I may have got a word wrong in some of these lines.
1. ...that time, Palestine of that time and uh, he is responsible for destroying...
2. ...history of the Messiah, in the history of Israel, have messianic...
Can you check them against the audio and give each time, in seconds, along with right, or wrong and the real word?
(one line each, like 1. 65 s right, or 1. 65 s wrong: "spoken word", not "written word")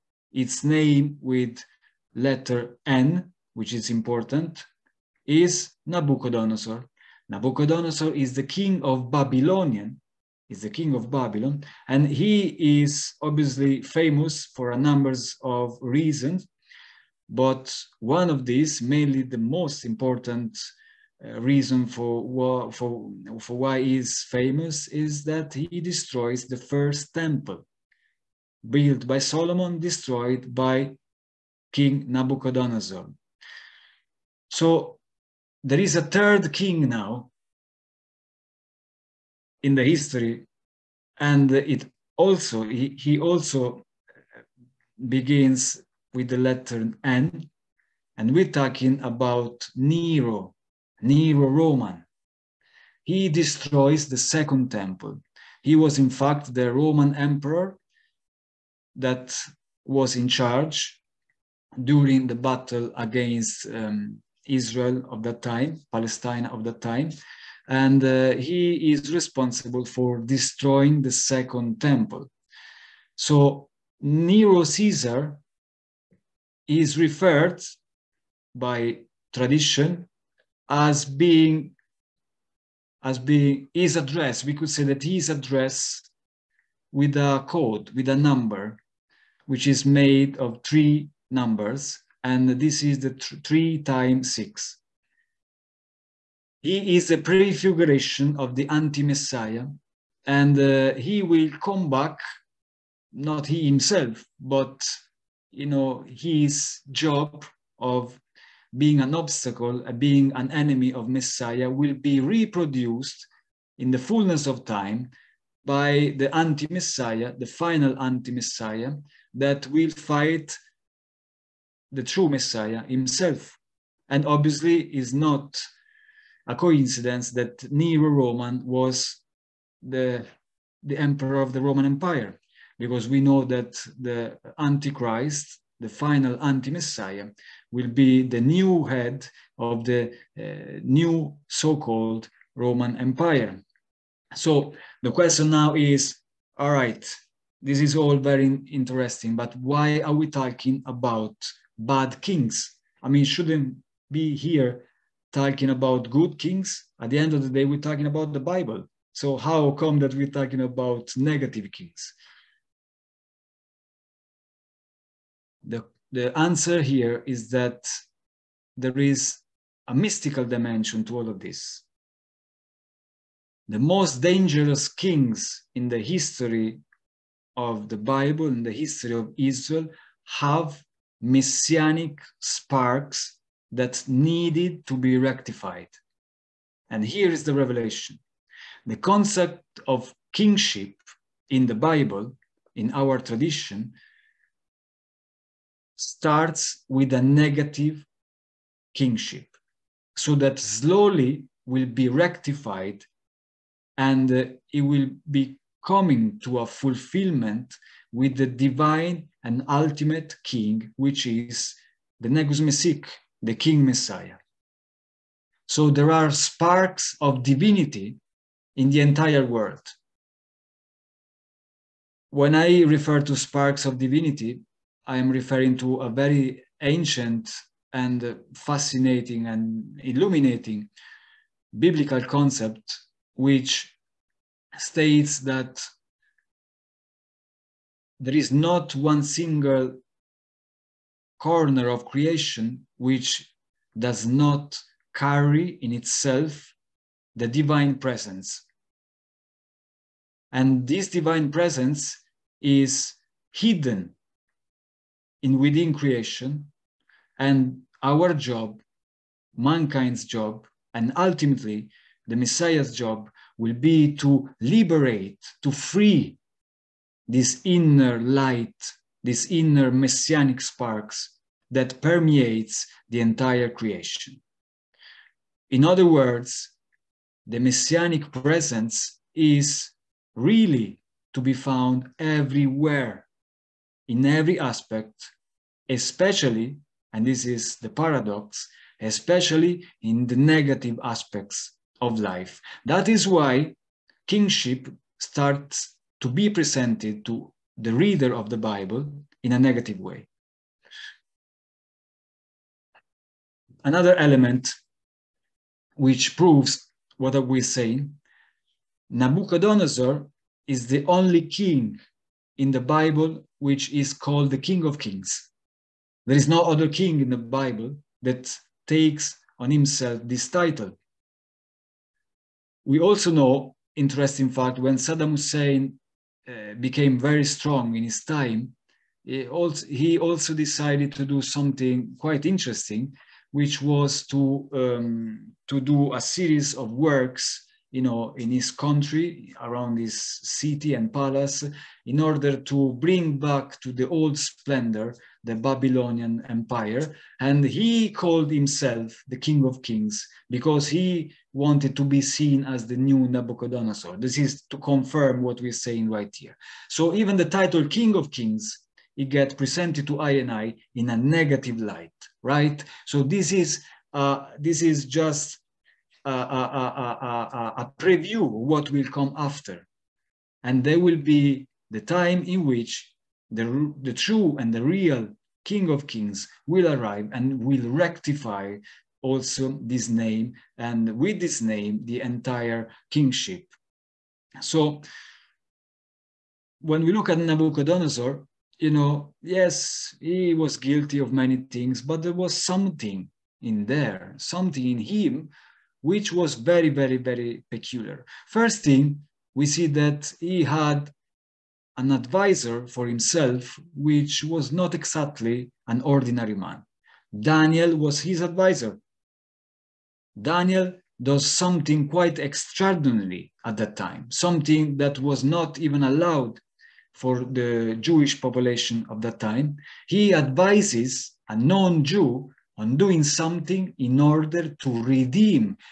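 1. 65 s right
2. 175 s wrong: "Bible", not "Messiah".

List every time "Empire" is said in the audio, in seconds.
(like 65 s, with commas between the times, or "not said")
131 s, 142 s, 346 s.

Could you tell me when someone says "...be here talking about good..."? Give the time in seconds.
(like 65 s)
154 s.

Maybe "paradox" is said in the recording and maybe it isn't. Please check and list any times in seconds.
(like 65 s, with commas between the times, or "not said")
287 s.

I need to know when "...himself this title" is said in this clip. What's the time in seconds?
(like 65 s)
319 s.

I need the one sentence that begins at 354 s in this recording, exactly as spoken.
This is to confirm what we're saying right here.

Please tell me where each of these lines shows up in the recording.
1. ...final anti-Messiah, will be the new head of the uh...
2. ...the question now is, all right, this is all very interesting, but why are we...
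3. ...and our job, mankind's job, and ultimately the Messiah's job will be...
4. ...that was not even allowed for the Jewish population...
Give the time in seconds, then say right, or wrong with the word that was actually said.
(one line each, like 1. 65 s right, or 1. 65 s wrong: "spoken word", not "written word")
1. 135 s right
2. 145 s right
3. 257 s right
4. 414 s right.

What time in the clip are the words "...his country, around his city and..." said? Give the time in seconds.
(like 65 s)
338 s.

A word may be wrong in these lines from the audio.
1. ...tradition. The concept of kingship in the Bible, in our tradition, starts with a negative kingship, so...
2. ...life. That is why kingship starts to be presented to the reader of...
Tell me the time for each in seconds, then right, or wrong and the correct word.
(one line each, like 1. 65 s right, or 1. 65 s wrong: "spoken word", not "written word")
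1. 187 s wrong: "revelation", not "tradition"
2. 292 s right.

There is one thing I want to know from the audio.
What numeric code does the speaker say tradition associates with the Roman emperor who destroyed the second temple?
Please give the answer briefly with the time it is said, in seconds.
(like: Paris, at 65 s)
Three times six, at 93 s.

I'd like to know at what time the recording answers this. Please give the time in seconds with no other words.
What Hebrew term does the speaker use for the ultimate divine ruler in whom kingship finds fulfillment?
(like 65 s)
212 s.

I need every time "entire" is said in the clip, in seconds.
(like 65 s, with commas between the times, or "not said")
219 s, 273 s, 382 s.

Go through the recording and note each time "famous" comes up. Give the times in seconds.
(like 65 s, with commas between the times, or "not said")
13 s, 24 s.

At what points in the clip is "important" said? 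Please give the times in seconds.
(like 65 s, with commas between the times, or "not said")
3 s, 19 s.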